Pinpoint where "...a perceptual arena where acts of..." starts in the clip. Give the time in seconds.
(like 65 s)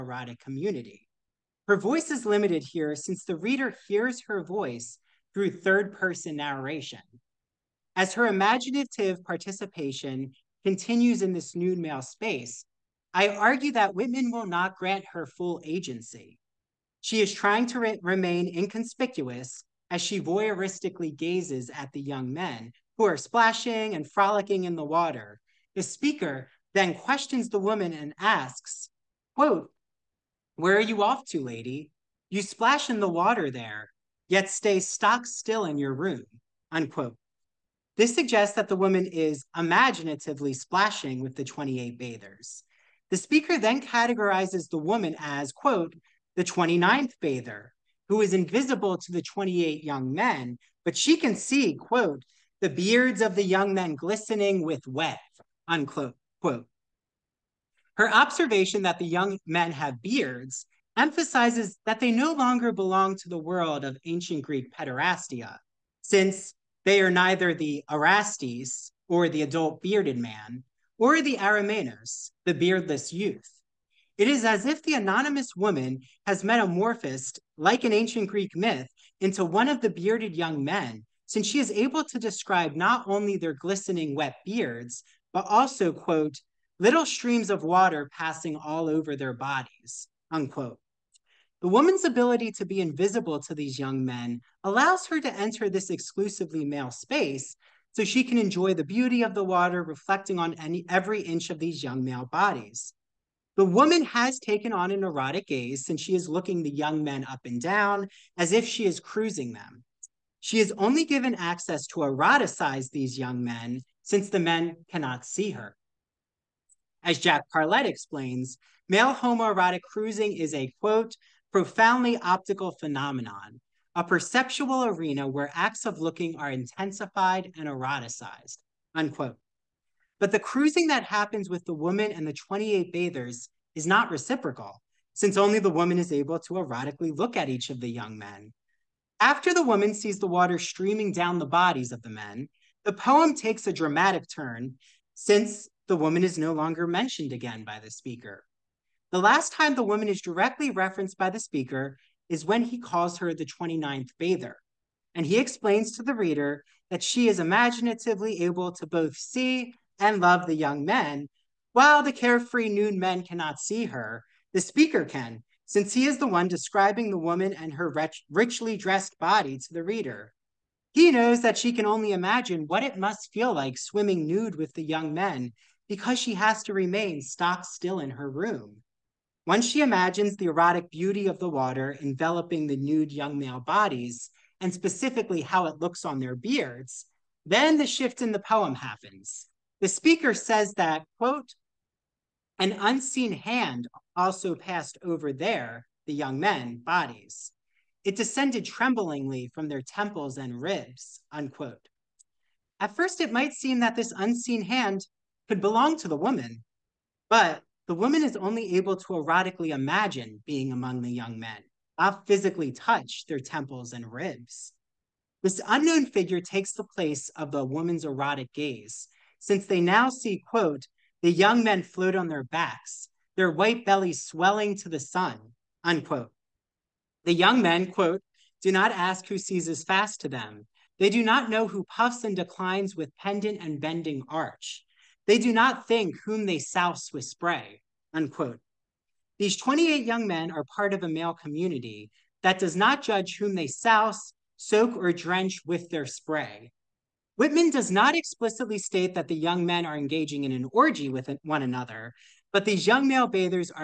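123 s.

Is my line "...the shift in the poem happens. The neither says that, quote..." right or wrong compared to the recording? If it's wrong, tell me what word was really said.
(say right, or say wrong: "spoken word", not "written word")
wrong: "speaker", not "neither".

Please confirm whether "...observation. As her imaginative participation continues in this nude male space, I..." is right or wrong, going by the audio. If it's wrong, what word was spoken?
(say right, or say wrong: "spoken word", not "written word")
wrong: "narration", not "observation".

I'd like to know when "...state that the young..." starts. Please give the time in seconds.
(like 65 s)
248 s.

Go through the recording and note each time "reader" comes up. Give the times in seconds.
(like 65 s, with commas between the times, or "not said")
3 s, 156 s, 169 s.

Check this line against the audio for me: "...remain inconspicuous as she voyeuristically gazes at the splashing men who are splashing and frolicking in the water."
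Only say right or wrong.
wrong.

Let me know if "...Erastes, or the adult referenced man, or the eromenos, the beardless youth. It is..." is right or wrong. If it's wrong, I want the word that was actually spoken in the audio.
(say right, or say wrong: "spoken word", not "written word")
wrong: "bearded", not "referenced".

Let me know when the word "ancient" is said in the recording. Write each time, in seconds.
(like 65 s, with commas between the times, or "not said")
64 s, 77 s.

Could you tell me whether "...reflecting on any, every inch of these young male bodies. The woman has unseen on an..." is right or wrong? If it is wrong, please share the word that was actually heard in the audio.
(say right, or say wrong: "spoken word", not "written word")
wrong: "taken", not "unseen".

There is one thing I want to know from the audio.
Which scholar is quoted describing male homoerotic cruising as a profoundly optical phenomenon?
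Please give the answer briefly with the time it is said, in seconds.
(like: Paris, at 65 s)
Jack Parlett, at 117 s.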